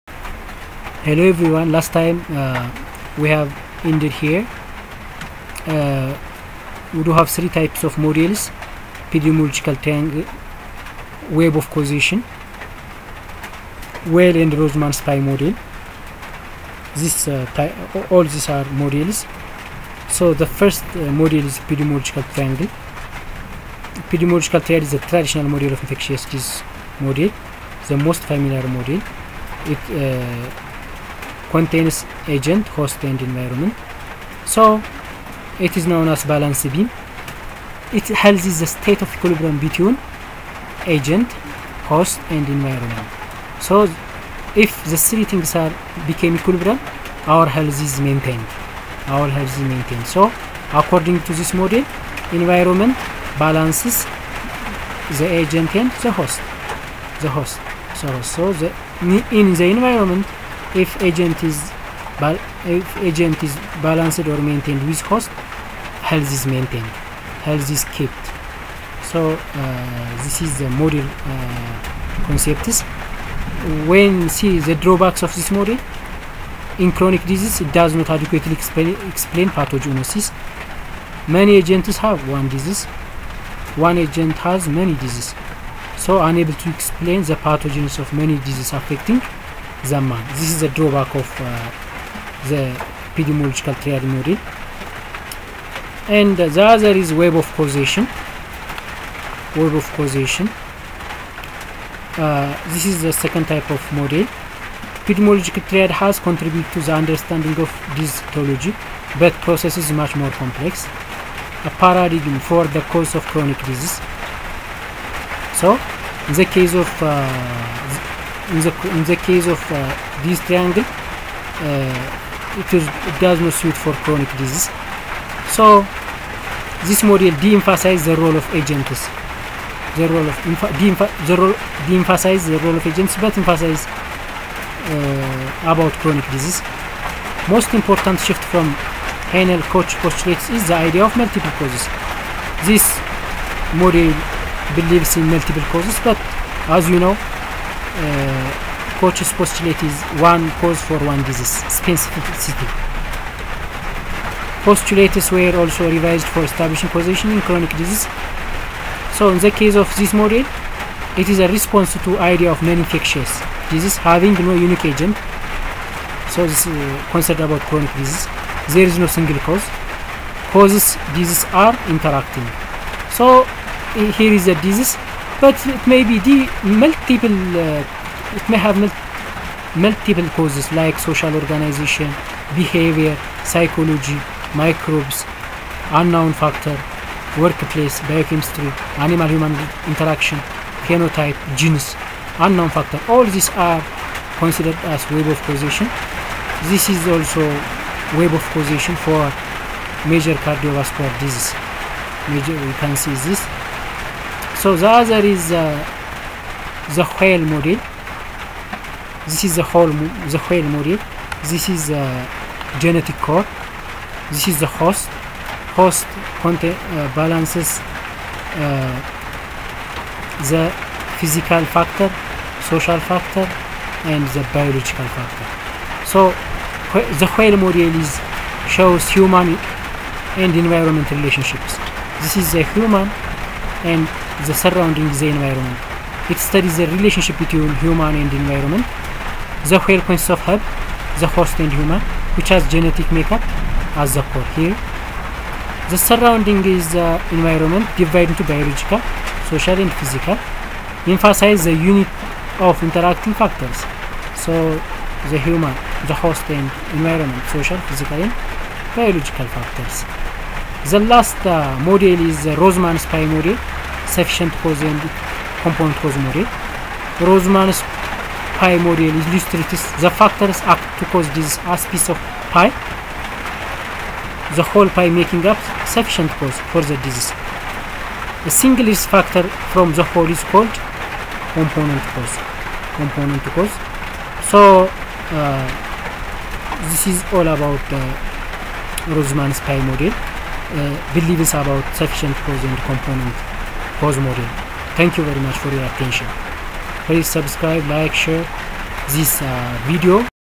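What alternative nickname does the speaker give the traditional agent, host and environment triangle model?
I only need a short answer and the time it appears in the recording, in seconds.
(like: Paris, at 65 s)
balance beam, at 36 s.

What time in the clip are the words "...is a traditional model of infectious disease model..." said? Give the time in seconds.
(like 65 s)
24 s.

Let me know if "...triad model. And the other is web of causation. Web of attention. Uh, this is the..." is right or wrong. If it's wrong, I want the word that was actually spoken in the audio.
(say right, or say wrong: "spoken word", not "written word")
wrong: "causation", not "attention".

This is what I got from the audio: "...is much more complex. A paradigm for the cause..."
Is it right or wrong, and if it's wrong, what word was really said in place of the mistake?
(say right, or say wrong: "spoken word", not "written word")
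right.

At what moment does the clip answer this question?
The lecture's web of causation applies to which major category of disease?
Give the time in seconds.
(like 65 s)
200 s.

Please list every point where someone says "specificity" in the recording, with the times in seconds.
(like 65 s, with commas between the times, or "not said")
151 s.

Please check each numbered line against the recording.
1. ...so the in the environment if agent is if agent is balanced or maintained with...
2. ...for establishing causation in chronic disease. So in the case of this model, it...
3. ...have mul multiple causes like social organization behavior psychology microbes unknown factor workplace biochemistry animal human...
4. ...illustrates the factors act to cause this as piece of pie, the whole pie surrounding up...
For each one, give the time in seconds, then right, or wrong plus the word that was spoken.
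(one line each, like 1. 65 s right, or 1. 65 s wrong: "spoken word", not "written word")
1. 58 s right
2. 156 s right
3. 178 s right
4. 269 s wrong: "making", not "surrounding".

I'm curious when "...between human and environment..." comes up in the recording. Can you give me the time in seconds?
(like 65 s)
237 s.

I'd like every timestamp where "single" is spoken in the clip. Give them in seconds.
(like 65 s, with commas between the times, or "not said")
169 s, 278 s.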